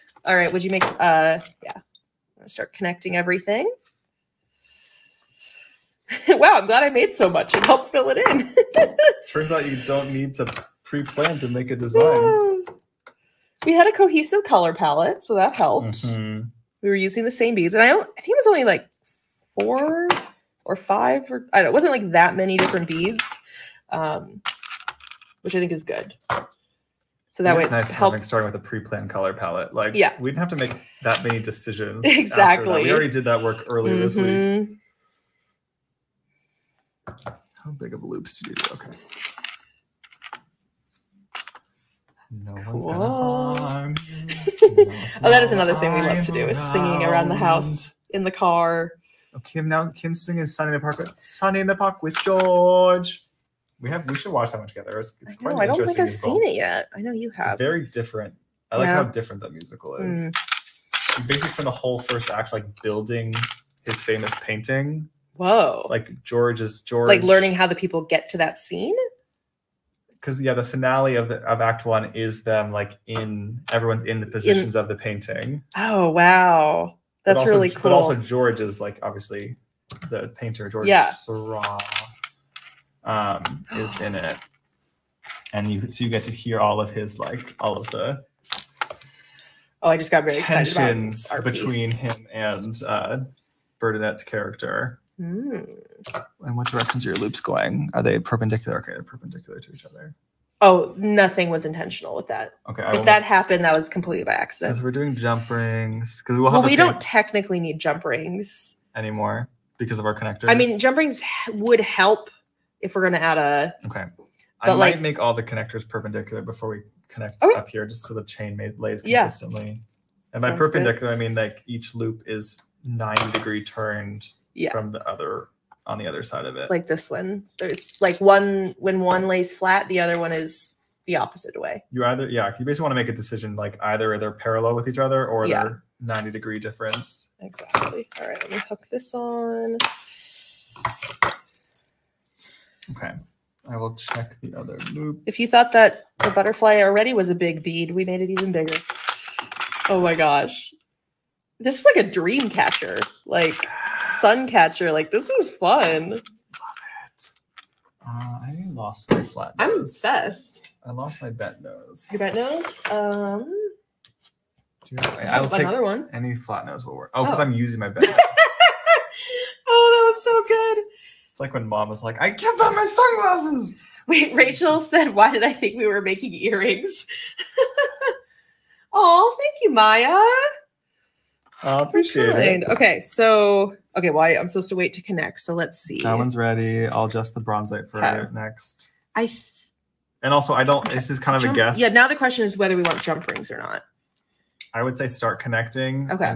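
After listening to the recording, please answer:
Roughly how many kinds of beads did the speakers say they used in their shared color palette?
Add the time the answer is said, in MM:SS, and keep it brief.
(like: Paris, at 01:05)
4 or 5, at 00:19.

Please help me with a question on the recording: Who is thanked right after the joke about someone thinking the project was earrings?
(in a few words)
Maya.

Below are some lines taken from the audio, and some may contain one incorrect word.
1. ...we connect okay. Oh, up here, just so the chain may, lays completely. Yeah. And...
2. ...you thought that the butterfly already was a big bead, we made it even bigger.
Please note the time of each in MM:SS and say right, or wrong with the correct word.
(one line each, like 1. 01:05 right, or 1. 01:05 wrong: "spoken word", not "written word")
1. 01:56 wrong: "consistently", not "completely"
2. 02:25 right.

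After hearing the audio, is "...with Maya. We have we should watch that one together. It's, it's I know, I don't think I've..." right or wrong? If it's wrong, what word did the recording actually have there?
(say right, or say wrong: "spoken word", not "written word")
wrong: "George", not "Maya".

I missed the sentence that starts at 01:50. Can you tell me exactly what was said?
I mean, jump rings would help if we're going to add a.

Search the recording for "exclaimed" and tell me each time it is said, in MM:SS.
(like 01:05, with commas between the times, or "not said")
not said.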